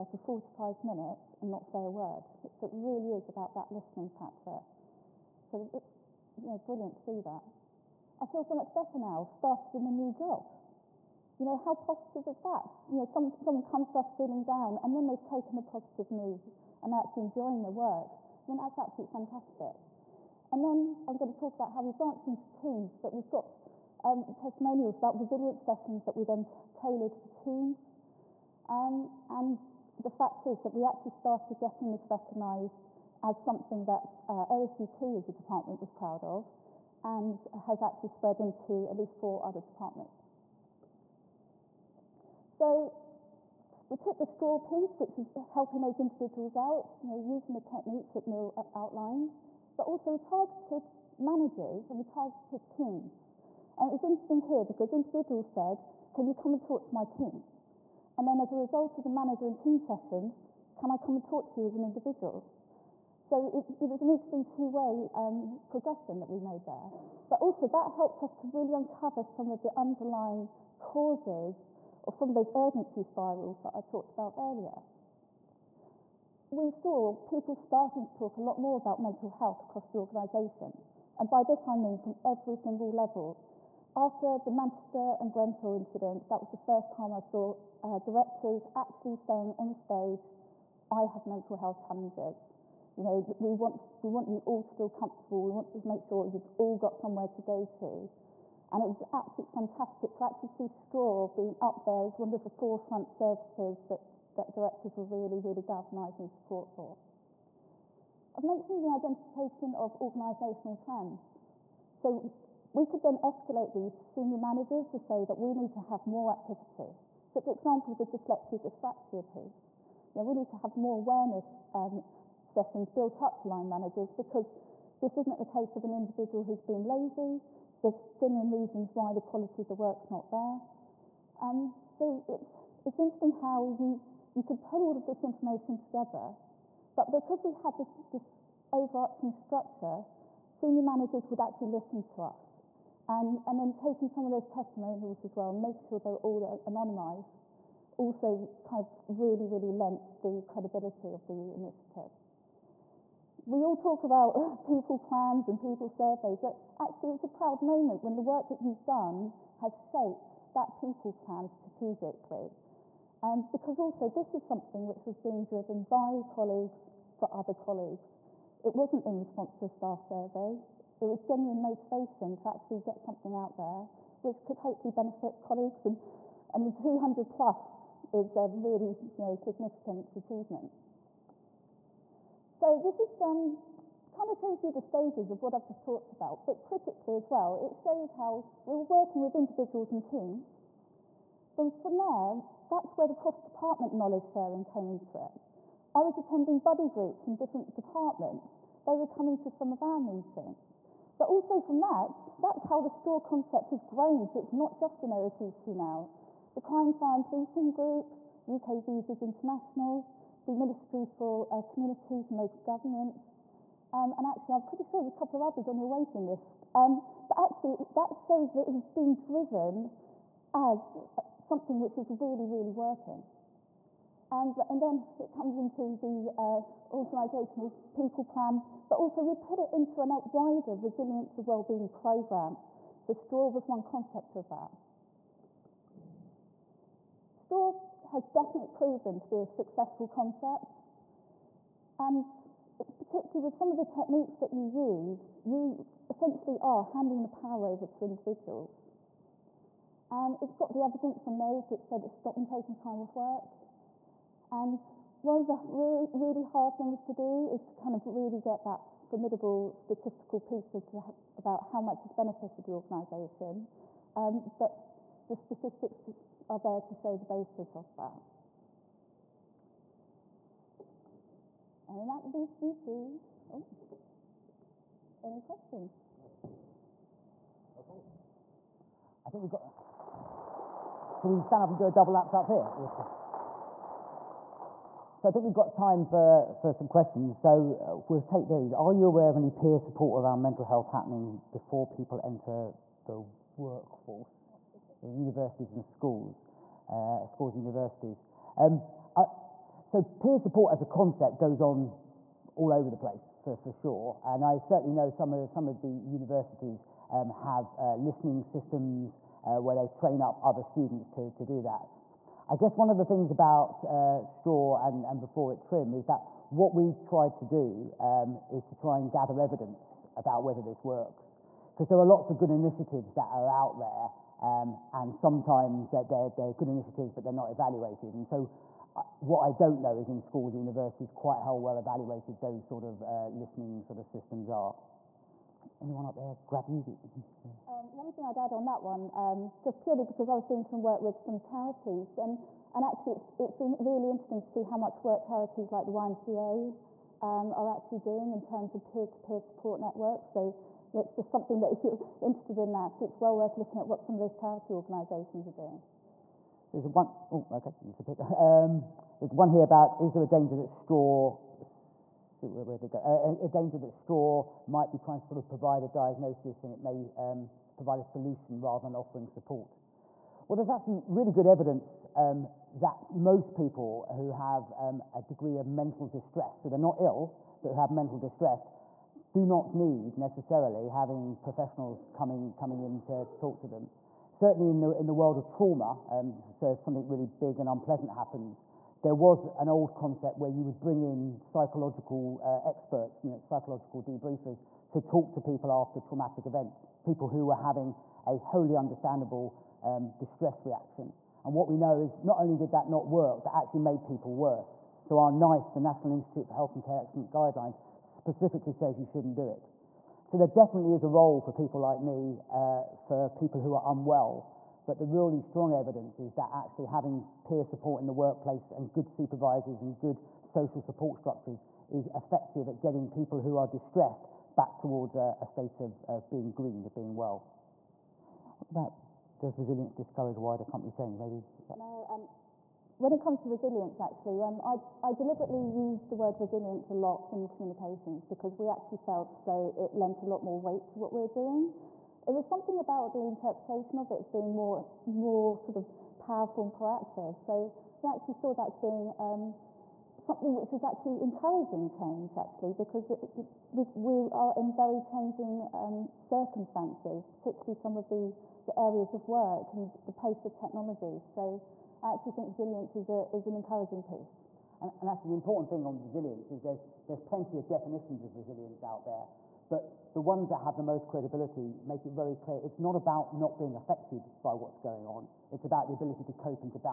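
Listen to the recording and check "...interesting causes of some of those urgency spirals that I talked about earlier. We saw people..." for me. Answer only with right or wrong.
wrong.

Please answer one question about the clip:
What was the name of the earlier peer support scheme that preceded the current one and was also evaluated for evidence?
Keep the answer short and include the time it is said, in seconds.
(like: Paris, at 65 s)
TRiM, at 315 s.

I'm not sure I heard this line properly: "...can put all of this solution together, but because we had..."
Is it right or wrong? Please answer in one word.
wrong.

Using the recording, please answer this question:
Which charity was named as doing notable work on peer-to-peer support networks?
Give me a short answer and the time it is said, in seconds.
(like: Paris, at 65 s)
YMCA, at 345 s.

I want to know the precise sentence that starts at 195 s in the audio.
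I was attending buddy groups in different departments.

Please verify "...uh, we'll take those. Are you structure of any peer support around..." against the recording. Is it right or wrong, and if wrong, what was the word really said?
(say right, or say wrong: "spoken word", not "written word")
wrong: "aware", not "structure".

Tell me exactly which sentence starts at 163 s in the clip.
Um, because also this is something which was being driven by colleagues for other colleagues.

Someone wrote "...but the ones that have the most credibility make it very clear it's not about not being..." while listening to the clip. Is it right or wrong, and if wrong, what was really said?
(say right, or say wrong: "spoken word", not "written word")
right.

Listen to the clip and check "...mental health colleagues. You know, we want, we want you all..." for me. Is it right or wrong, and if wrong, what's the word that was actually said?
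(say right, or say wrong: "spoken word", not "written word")
wrong: "challenges", not "colleagues".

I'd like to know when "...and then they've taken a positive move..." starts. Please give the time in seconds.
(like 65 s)
14 s.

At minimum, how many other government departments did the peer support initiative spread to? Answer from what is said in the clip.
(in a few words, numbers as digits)
4.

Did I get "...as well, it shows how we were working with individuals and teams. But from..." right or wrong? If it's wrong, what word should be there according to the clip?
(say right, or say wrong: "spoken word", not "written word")
right.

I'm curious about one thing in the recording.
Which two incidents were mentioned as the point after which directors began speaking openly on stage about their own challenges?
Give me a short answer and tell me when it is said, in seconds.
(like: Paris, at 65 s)
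Manchester and Grenfell, at 84 s.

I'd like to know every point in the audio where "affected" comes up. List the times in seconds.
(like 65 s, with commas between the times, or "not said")
473 s.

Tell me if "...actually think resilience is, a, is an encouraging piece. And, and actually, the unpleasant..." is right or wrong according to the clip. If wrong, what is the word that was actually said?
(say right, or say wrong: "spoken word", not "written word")
wrong: "important", not "unpleasant".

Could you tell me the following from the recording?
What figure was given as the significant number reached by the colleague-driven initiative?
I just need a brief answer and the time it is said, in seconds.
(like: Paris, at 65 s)
200 plus, at 176 s.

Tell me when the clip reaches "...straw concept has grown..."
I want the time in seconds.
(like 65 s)
202 s.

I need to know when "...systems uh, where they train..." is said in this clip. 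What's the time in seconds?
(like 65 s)
308 s.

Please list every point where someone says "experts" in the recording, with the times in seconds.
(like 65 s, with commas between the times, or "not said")
392 s.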